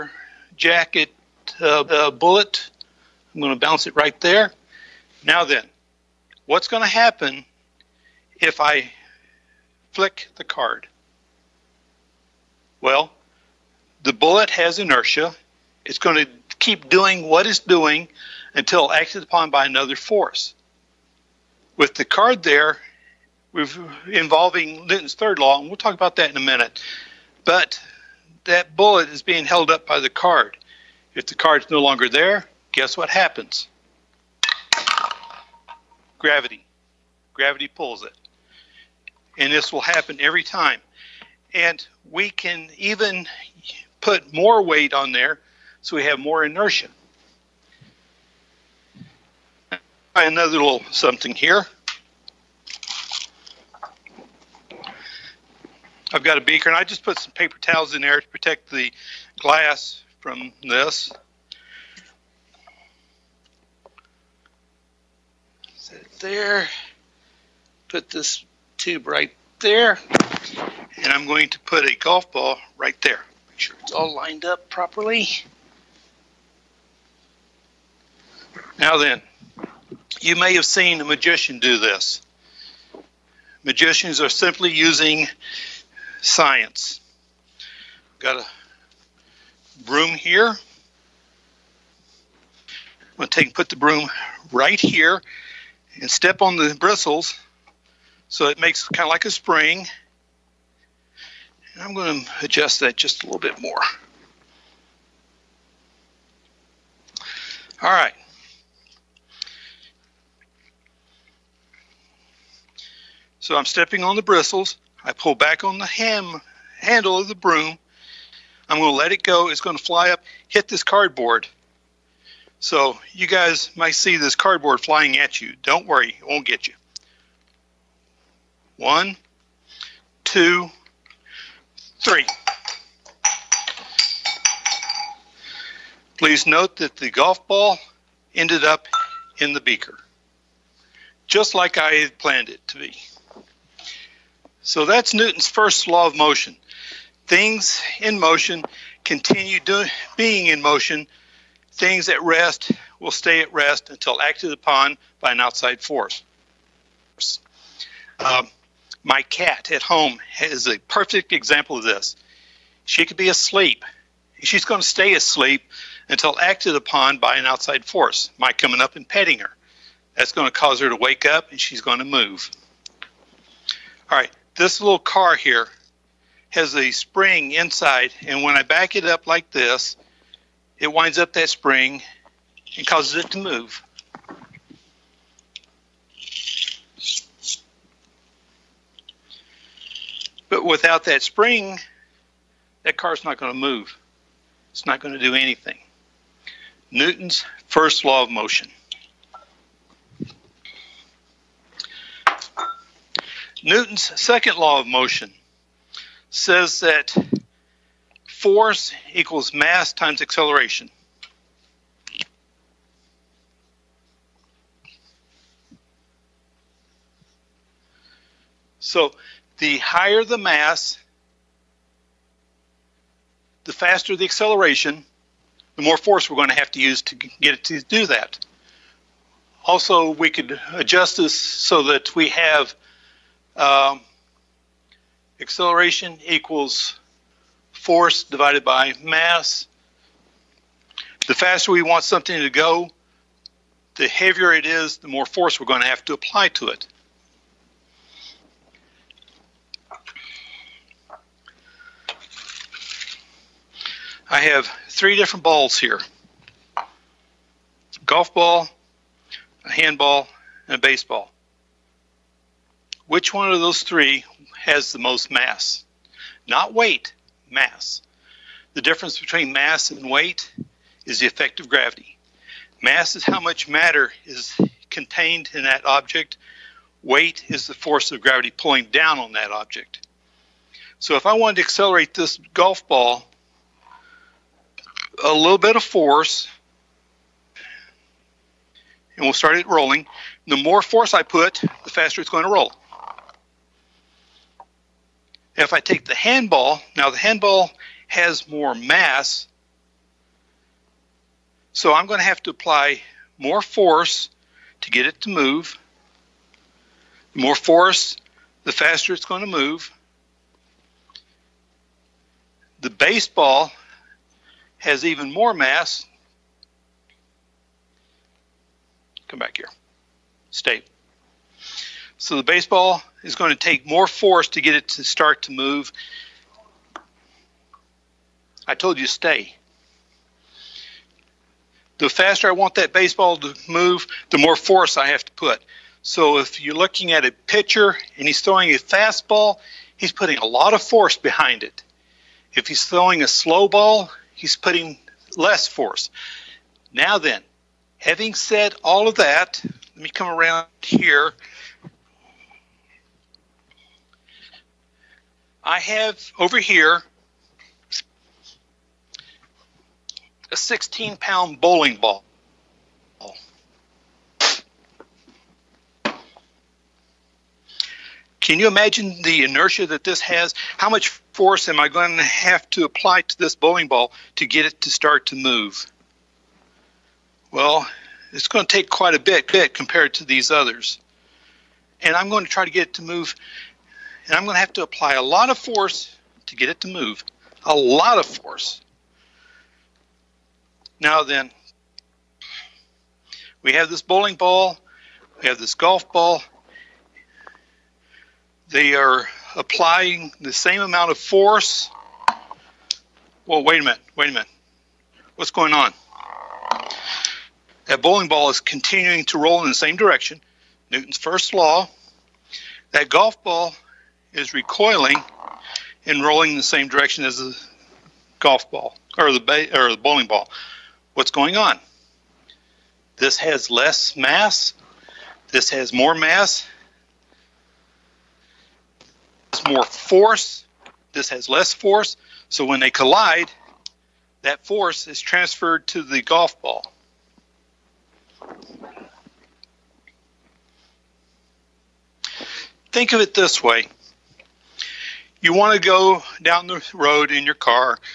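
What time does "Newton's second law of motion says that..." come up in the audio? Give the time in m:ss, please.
3:23.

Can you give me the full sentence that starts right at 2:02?
So you guys might see this cardboard flying at you.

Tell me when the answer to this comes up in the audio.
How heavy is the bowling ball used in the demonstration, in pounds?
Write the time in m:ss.
6:00.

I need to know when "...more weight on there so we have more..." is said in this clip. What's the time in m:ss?
0:44.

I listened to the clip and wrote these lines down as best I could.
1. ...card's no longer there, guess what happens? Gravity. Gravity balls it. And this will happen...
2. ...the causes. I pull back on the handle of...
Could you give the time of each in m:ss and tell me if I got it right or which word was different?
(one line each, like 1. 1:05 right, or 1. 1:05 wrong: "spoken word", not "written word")
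1. 0:31 wrong: "pulls", not "balls"
2. 1:54 wrong: "bristles", not "causes".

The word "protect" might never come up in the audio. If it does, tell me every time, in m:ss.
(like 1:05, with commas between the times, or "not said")
0:58.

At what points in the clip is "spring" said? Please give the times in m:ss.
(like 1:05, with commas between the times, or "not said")
1:39, 2:56, 3:01, 3:11.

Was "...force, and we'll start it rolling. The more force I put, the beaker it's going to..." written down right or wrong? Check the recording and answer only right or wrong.
wrong.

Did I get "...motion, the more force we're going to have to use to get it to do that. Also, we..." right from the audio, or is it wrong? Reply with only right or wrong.
wrong.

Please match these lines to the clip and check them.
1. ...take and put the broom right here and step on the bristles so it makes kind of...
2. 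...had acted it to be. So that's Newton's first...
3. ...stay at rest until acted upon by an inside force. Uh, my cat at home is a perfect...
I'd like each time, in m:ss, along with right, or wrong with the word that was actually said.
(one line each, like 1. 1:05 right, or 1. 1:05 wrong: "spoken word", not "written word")
1. 1:33 right
2. 2:21 wrong: "planned", not "acted"
3. 2:33 wrong: "outside", not "inside".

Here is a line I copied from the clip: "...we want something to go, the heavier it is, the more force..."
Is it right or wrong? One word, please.
right.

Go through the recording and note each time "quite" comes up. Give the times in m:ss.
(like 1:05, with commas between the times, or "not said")
6:18.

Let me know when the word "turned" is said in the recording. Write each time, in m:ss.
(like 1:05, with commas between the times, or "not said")
not said.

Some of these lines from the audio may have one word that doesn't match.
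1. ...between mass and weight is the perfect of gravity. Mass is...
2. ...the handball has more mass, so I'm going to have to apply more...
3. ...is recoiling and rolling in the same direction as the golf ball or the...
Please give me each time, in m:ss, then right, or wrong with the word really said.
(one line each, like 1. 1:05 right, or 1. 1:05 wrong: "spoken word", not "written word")
1. 4:29 wrong: "effect", not "perfect"
2. 4:57 right
3. 6:54 right.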